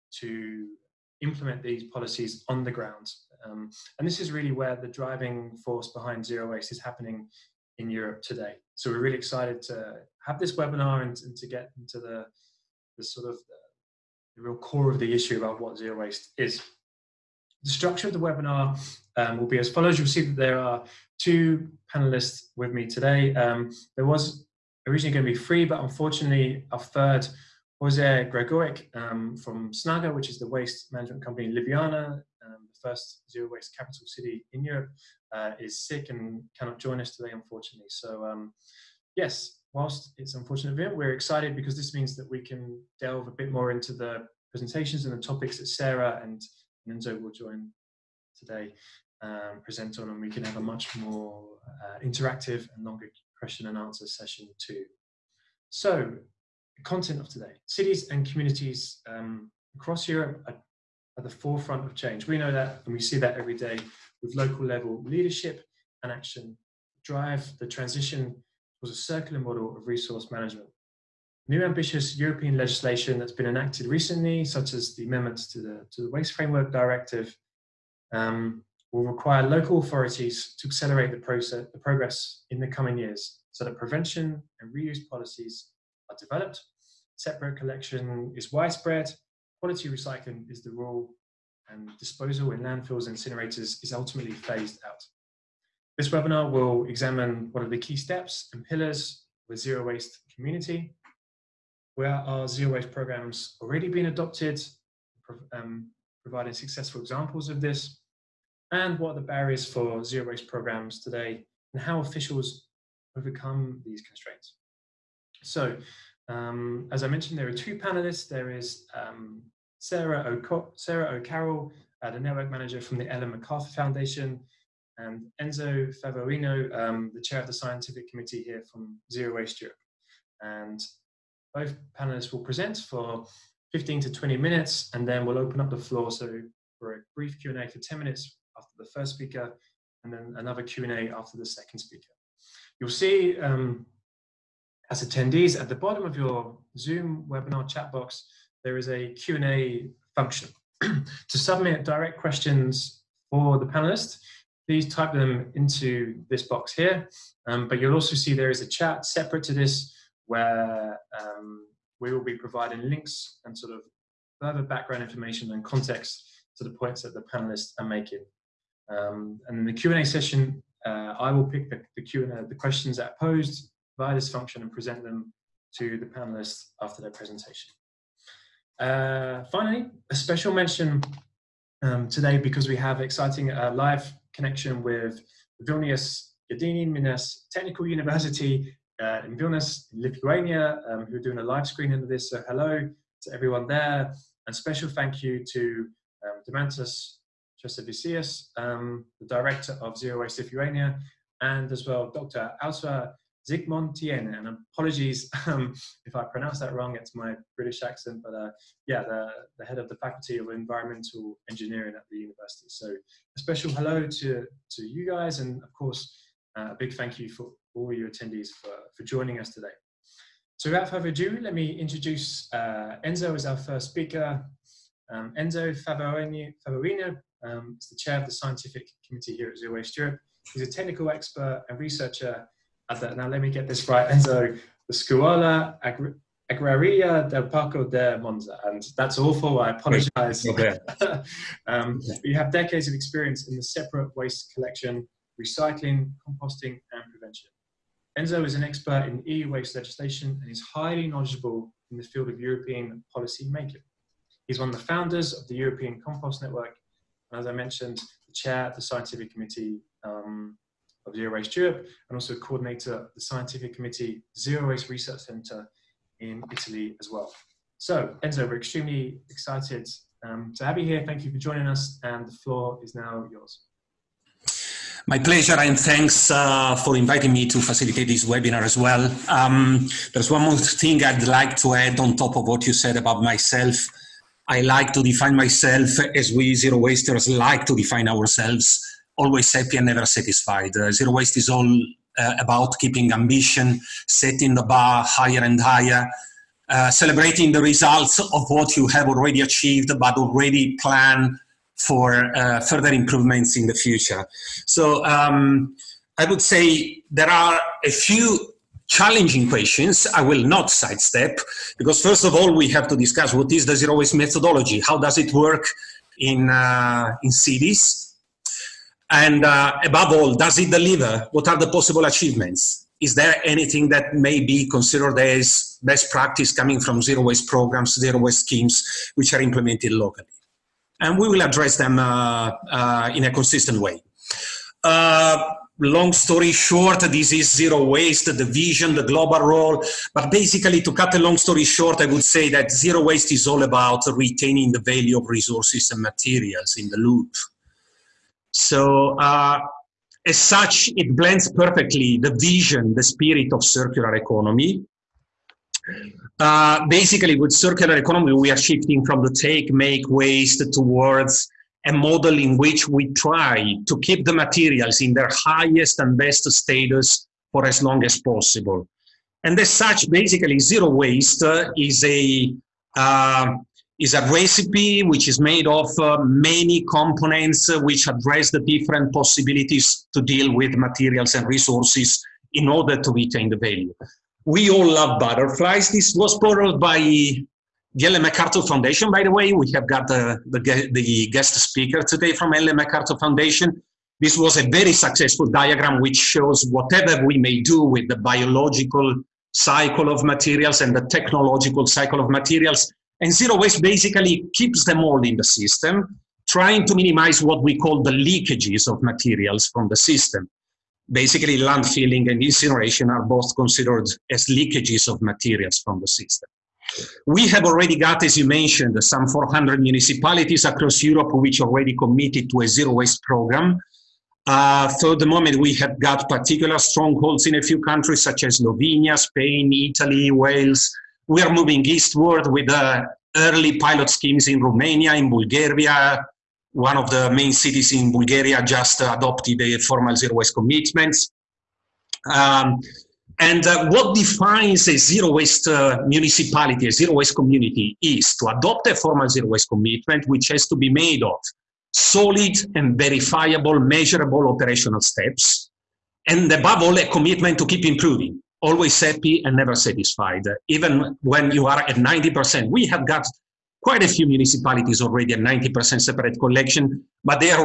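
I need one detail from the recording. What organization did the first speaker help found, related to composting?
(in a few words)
European Compost Network.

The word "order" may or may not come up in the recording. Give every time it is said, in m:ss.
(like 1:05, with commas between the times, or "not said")
6:22.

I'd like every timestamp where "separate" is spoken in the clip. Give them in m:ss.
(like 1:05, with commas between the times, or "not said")
1:27, 2:39, 4:03, 7:46.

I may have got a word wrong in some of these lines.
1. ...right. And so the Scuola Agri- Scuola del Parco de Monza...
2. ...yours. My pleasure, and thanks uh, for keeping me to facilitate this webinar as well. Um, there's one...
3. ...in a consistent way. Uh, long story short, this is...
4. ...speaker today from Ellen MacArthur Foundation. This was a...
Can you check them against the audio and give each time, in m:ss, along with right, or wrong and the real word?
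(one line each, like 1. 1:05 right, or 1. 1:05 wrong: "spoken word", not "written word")
1. 3:53 wrong: "Agraria", not "Scuola"
2. 4:33 wrong: "inviting", not "keeping"
3. 5:33 right
4. 6:31 right.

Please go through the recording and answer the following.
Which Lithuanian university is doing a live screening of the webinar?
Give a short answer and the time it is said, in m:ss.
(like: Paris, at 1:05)
Vilnius Gediminas Technical University, at 3:05.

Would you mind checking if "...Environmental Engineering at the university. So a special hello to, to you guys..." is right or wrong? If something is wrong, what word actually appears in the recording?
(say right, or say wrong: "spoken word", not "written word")
right.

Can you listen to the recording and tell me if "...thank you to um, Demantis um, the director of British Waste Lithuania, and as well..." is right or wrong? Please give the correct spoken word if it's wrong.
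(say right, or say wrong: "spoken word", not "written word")
wrong: "Zero", not "British".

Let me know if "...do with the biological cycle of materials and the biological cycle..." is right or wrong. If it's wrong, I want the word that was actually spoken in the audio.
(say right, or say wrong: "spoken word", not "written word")
wrong: "technological", not "biological".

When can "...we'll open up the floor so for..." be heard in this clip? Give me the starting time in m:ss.
2:15.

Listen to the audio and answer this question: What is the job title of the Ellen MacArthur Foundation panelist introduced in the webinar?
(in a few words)
Network manager.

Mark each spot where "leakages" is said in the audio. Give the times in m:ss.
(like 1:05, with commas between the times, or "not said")
6:48, 6:54.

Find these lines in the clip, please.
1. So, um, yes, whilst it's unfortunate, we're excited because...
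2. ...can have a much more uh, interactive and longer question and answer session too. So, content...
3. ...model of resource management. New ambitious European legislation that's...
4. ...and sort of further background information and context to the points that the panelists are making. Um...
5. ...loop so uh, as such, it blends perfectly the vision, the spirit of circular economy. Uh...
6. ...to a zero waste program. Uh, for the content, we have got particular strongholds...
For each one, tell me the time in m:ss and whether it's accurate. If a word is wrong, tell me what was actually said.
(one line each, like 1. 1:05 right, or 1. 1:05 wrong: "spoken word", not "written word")
1. 0:37 right
2. 0:50 right
3. 1:09 right
4. 2:43 right
5. 5:46 right
6. 7:02 wrong: "moment", not "content".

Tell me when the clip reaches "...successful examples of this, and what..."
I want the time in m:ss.
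1:46.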